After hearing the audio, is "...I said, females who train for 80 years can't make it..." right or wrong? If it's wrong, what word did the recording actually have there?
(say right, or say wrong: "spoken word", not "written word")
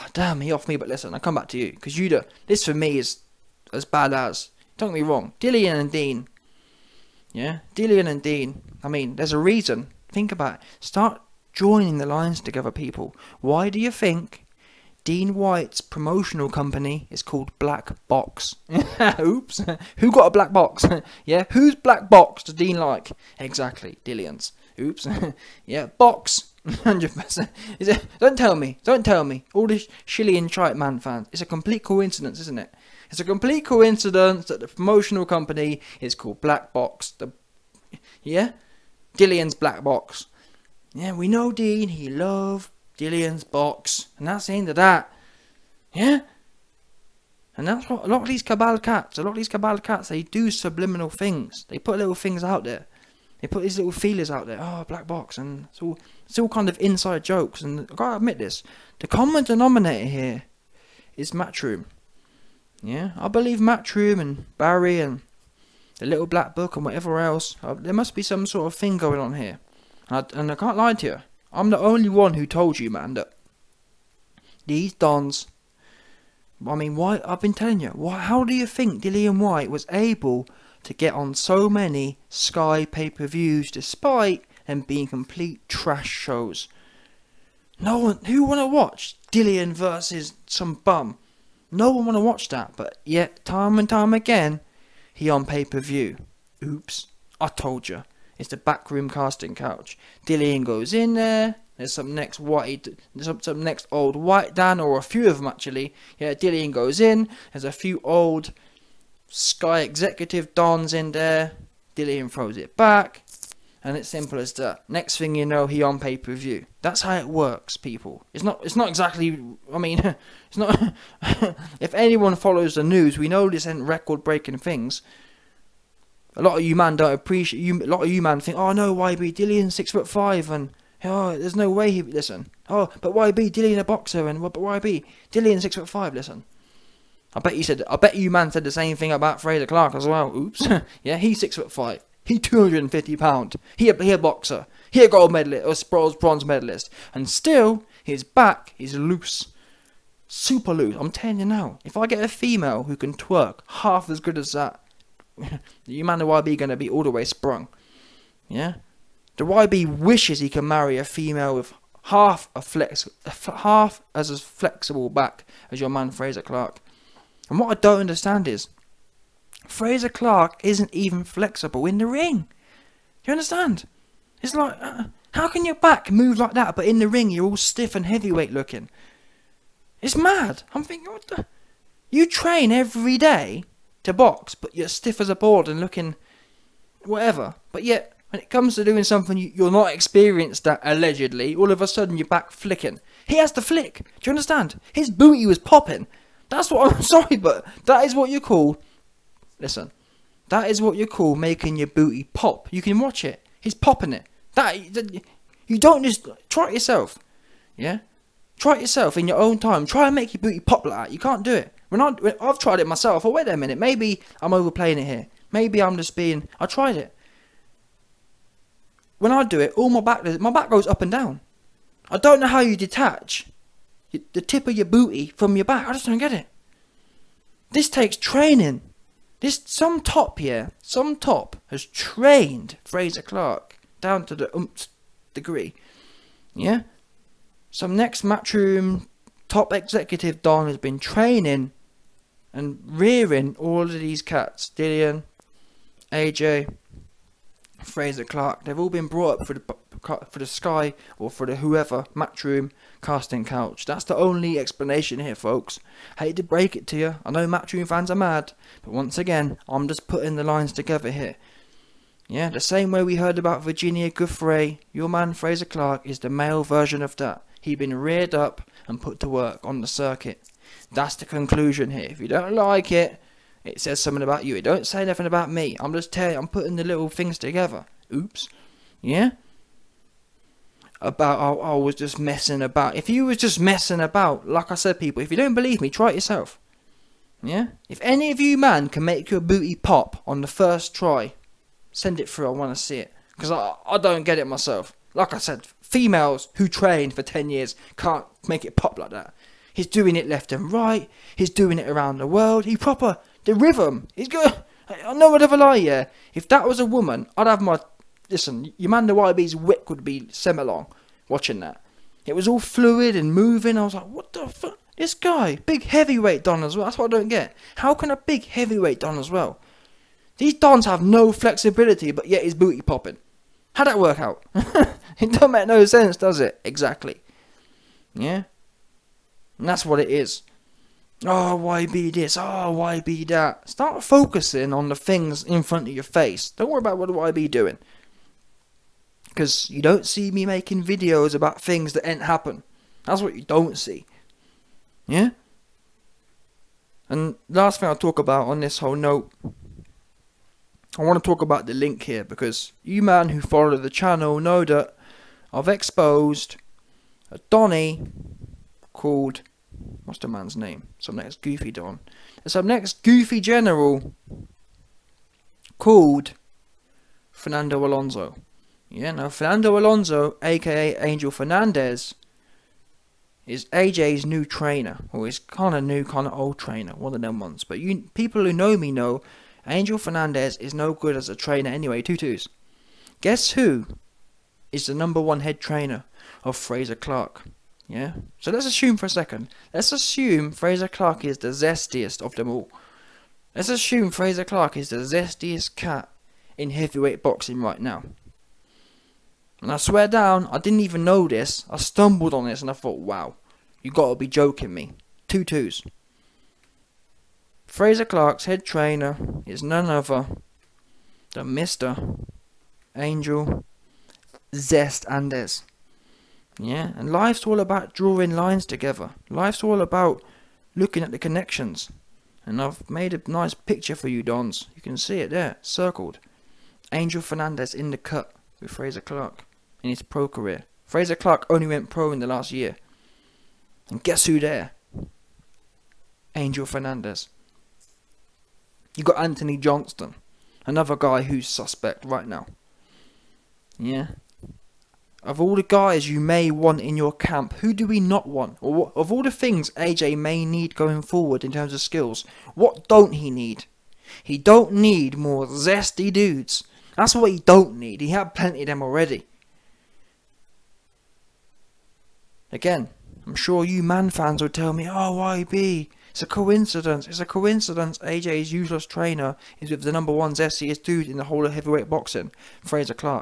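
wrong: "10", not "80".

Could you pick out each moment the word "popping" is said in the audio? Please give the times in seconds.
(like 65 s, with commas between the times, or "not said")
195 s, 203 s, 322 s.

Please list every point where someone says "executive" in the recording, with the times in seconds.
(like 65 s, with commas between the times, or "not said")
109 s, 239 s.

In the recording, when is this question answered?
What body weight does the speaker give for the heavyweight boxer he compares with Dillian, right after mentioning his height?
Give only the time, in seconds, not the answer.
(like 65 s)
142 s.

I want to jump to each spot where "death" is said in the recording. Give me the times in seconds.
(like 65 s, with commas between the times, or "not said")
not said.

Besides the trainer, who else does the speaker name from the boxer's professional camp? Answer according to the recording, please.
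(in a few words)
Anthony Johnston.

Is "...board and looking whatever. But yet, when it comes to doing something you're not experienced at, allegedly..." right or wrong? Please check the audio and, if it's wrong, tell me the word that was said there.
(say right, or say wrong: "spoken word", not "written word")
right.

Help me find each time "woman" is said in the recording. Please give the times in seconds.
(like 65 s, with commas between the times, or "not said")
306 s.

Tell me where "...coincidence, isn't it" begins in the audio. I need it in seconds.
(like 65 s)
31 s.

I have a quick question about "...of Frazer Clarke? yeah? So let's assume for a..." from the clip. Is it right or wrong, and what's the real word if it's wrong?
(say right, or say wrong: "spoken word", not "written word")
right.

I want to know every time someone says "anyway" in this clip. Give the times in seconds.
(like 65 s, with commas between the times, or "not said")
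381 s.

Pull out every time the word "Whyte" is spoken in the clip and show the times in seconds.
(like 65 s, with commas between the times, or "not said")
15 s, 79 s.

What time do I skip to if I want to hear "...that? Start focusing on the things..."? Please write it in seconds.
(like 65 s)
333 s.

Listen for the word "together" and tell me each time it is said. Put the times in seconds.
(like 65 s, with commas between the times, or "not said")
12 s, 260 s, 277 s, 418 s.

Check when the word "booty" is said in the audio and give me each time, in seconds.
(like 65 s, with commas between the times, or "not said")
195 s, 201 s, 210 s, 224 s, 289 s, 322 s.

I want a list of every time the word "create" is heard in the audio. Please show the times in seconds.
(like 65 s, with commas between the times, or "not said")
not said.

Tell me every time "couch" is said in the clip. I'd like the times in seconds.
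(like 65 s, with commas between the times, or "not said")
99 s, 253 s.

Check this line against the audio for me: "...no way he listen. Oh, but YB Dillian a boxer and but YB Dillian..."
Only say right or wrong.
right.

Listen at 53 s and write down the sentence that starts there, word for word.
They put these little feelers out there.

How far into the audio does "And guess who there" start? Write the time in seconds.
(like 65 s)
433 s.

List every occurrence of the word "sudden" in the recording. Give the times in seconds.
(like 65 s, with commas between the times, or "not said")
191 s.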